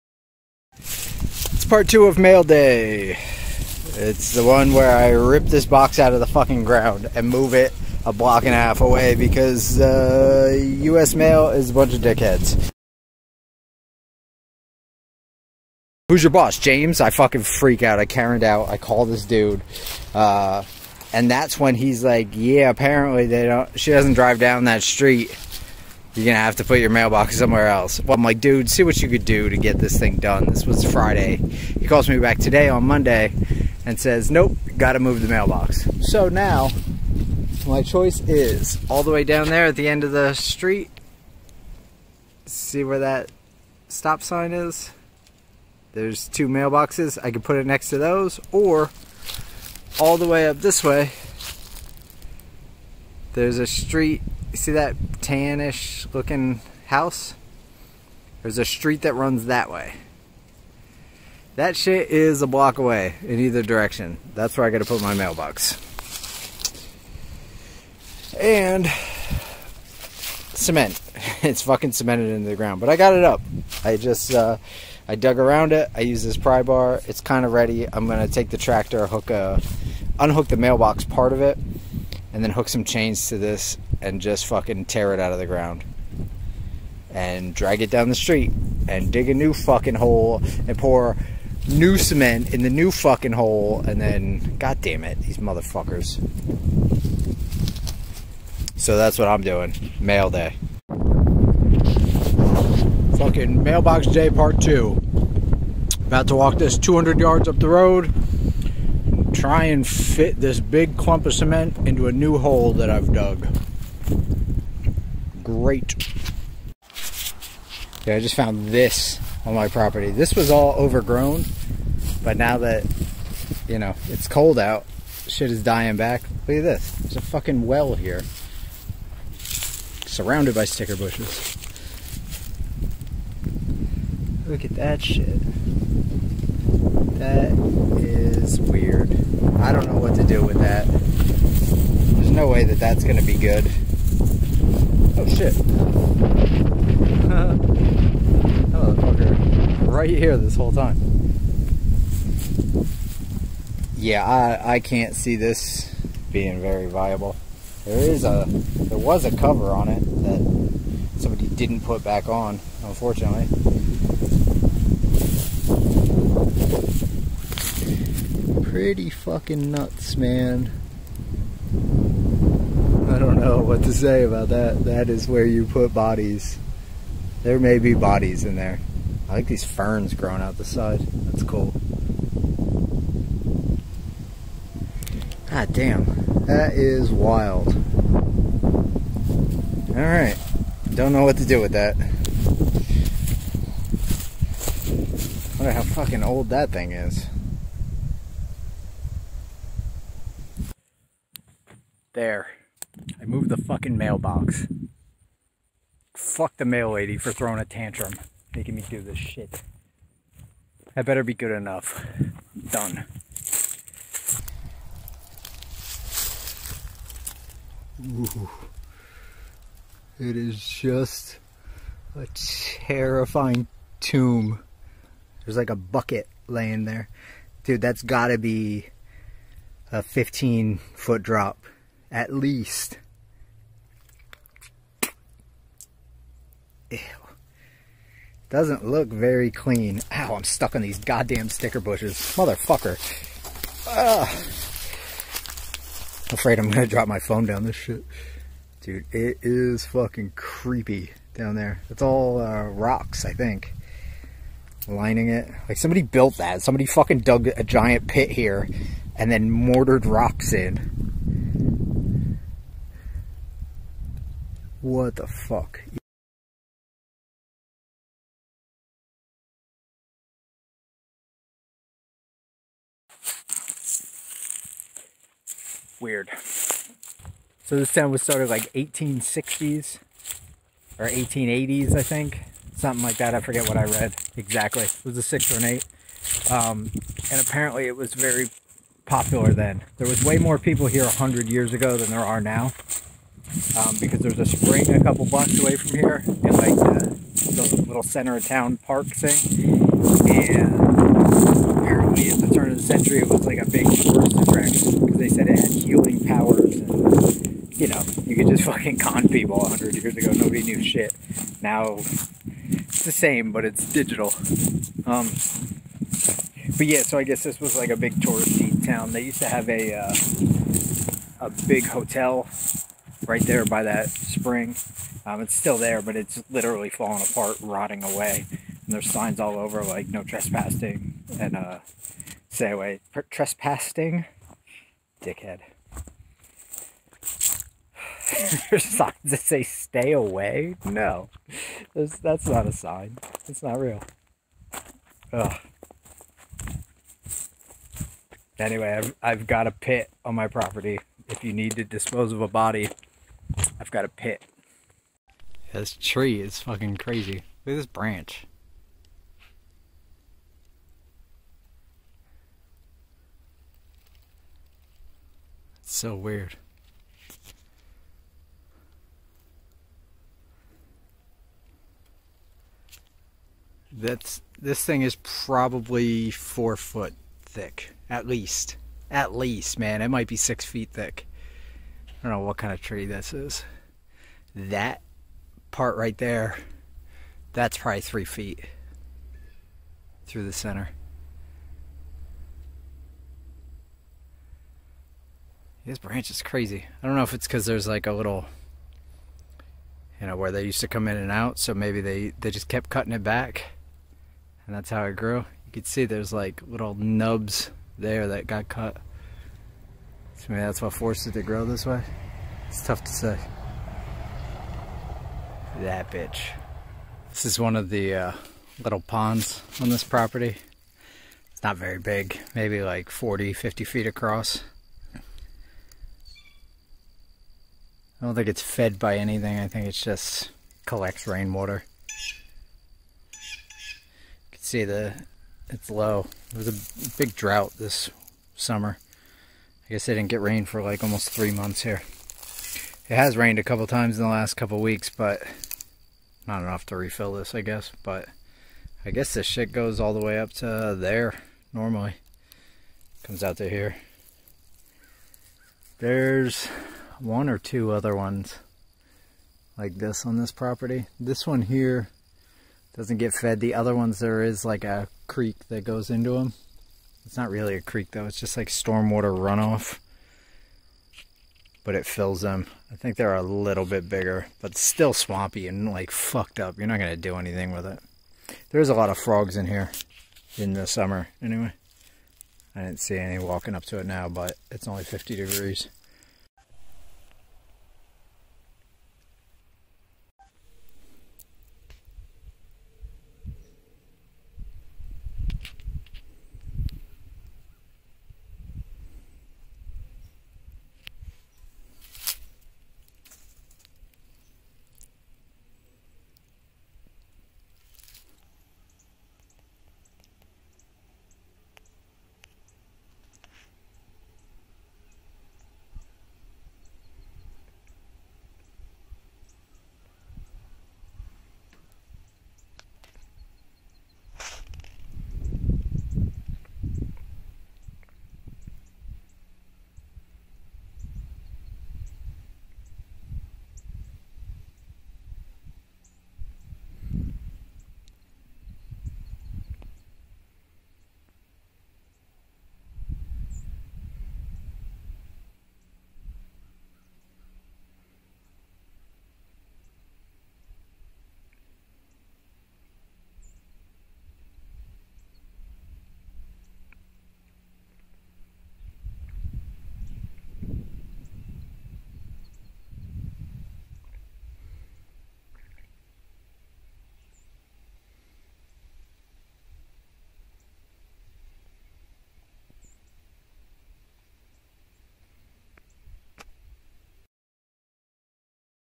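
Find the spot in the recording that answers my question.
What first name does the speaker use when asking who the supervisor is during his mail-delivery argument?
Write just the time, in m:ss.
0:16.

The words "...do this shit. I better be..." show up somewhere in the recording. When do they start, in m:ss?
3:28.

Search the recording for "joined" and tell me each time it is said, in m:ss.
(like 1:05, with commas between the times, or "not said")
not said.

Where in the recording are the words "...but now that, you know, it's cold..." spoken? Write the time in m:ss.
2:02.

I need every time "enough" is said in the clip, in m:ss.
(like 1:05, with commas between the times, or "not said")
3:31, 7:26.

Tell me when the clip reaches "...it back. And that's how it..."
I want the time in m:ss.
6:43.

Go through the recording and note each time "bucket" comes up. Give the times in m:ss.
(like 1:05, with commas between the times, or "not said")
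3:45.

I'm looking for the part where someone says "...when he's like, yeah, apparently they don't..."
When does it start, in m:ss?
0:21.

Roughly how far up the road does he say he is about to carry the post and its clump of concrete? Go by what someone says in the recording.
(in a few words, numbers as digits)
200 yards.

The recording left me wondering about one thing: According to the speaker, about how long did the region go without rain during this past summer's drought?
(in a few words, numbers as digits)
Almost 3 months.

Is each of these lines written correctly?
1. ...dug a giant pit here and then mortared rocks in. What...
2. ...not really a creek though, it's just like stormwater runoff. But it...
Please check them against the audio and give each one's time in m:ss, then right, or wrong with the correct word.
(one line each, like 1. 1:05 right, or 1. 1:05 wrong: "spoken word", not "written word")
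1. 4:17 right
2. 7:47 right.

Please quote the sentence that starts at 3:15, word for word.
wonder how fucking old that thing is.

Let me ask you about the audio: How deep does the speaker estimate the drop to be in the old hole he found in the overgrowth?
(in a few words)
15 feet.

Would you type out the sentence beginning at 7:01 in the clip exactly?
It's not very big, maybe like 40, 50 feet across.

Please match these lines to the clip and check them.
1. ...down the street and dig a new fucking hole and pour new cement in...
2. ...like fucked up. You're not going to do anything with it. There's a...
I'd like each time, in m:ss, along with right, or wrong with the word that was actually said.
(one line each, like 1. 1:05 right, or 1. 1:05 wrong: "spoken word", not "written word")
1. 1:27 right
2. 7:55 right.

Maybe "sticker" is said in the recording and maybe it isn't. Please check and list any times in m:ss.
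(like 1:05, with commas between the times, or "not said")
2:10, 4:01.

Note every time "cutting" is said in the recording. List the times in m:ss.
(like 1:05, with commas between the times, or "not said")
6:42.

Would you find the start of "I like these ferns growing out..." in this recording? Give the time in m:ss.
2:59.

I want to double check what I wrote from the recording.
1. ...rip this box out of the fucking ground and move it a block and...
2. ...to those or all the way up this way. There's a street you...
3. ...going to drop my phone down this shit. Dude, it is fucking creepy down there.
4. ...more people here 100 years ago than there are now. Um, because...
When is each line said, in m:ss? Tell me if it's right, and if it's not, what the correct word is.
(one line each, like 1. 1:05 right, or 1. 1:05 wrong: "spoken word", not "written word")
1. 0:05 right
2. 0:47 right
3. 4:06 right
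4. 4:50 right.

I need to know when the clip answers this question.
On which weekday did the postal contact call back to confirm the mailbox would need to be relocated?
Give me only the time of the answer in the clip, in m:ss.
0:32.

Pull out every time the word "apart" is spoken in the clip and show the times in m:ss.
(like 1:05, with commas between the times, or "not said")
5:27.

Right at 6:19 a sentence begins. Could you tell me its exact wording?
At least, man, it might be six feet thick.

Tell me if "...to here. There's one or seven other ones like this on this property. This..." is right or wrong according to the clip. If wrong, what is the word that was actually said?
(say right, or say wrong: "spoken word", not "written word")
wrong: "two", not "seven".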